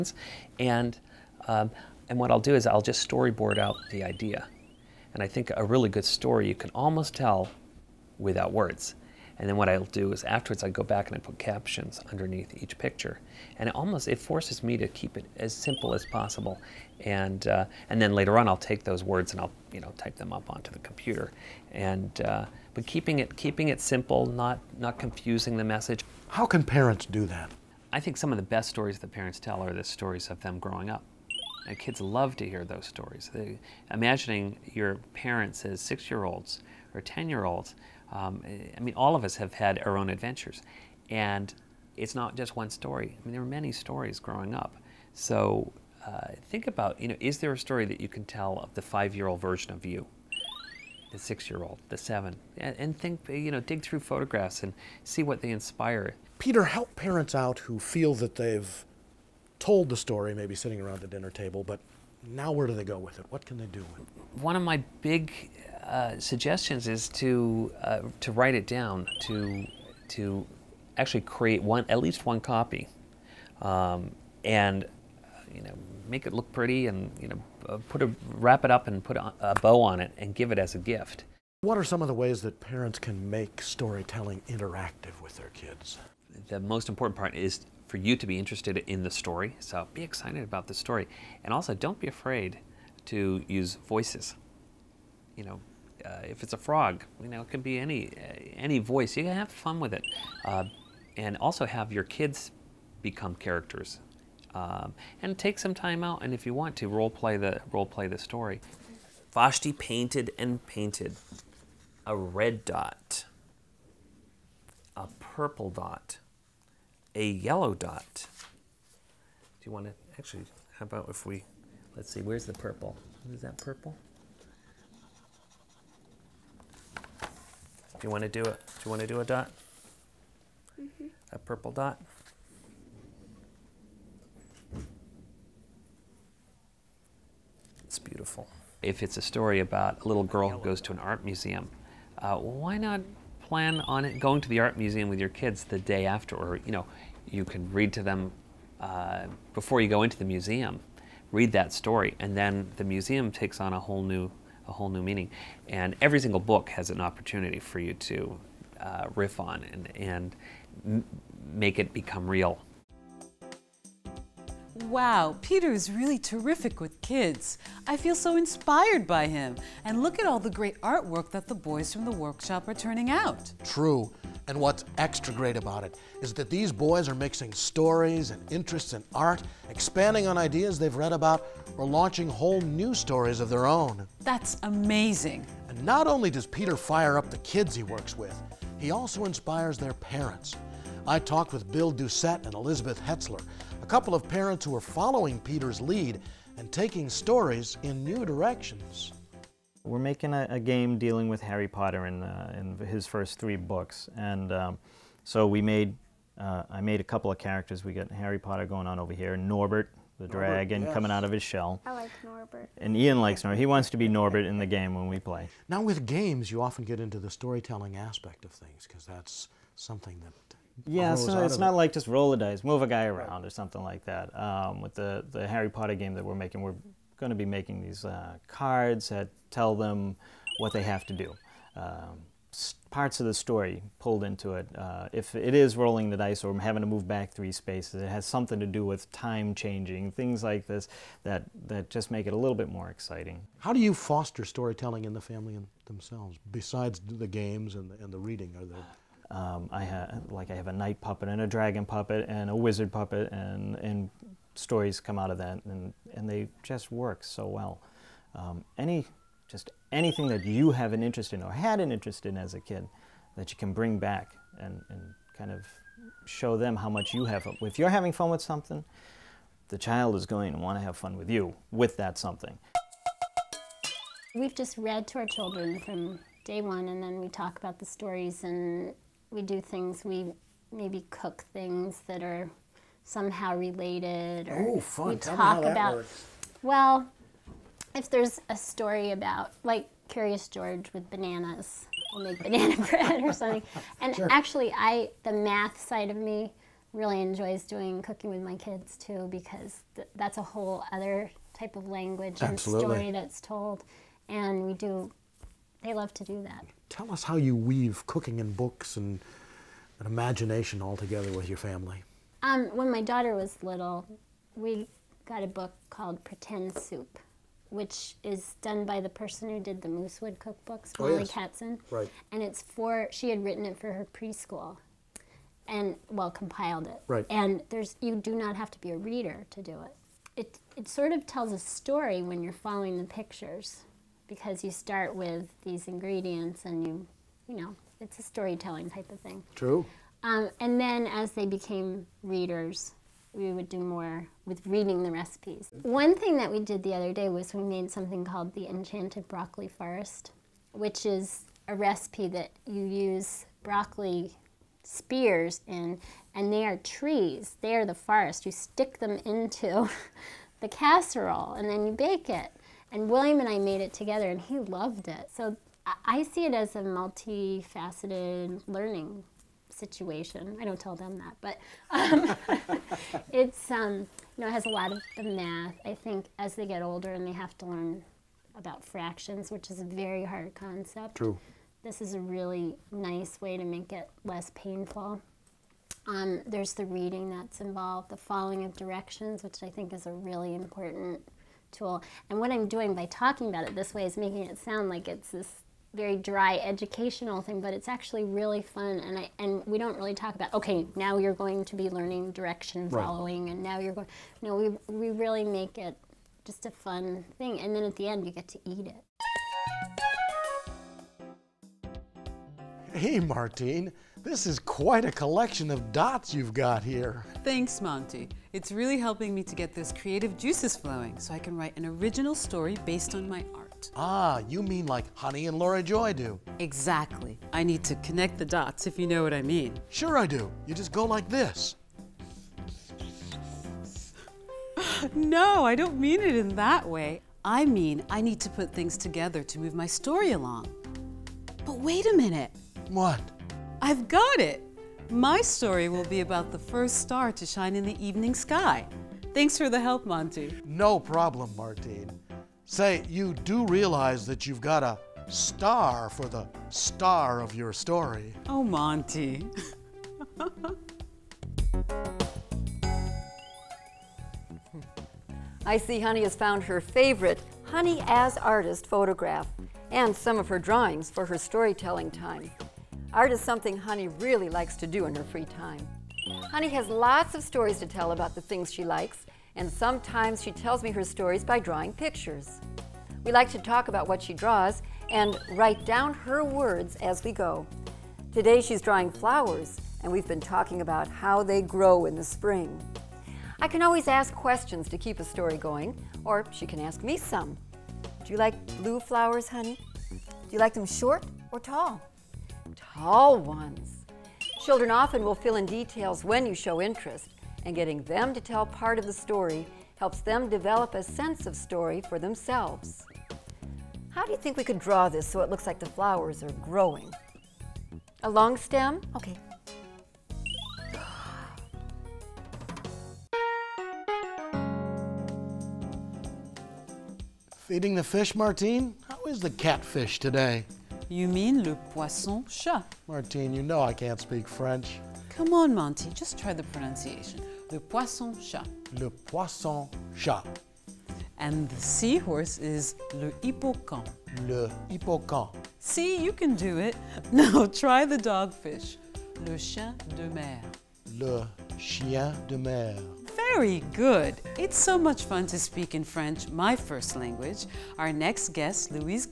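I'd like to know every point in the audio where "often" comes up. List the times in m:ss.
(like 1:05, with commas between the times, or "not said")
3:36, 8:24.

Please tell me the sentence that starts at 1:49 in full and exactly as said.
Vashti painted and painted a red dot, a purple dot, a yellow dot.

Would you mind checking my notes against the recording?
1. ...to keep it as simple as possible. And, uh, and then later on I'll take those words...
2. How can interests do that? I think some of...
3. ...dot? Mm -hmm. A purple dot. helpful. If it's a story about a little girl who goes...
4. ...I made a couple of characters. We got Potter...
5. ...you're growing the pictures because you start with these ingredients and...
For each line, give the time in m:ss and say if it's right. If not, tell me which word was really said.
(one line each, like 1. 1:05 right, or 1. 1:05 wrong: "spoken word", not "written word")
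1. 0:14 right
2. 0:26 wrong: "parents", not "interests"
3. 2:09 right
4. 3:26 wrong: "Harry", not "Potter"
5. 5:32 wrong: "following", not "growing".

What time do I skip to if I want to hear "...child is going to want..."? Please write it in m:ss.
4:29.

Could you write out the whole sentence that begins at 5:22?
And it's for, she had written it for her preschool and, well, compiled it.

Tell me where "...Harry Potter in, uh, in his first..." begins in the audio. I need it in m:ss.
3:21.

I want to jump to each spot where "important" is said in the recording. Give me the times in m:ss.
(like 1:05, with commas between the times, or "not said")
1:26, 6:30.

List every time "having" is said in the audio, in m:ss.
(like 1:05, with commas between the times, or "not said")
3:56, 4:27.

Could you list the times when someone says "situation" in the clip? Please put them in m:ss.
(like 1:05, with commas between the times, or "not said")
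6:09.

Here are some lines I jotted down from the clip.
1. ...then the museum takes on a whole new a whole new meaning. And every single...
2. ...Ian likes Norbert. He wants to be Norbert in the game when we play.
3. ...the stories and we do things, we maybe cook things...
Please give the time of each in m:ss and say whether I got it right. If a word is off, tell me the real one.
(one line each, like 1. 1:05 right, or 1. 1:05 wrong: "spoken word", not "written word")
1. 2:32 right
2. 3:32 right
3. 4:37 right.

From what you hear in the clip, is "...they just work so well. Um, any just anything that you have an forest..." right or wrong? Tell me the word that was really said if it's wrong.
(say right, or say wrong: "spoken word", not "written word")
wrong: "interest", not "forest".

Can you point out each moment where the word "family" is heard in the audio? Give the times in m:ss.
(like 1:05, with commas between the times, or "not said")
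4:05, 5:11.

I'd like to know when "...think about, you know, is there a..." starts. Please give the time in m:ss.
0:46.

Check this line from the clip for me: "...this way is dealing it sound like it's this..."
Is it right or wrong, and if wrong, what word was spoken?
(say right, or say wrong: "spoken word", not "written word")
wrong: "making", not "dealing".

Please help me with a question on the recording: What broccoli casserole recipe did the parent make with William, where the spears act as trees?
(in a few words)
Enchanted Broccoli Forest.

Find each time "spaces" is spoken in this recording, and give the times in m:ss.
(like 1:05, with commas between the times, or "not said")
3:57.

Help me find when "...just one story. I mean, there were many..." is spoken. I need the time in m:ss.
0:42.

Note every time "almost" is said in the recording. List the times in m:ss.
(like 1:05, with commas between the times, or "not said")
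0:06, 0:13.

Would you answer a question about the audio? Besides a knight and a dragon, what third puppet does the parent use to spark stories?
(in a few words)
wizard.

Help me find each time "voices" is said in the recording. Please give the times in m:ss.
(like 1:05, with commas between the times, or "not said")
1:33, 1:38.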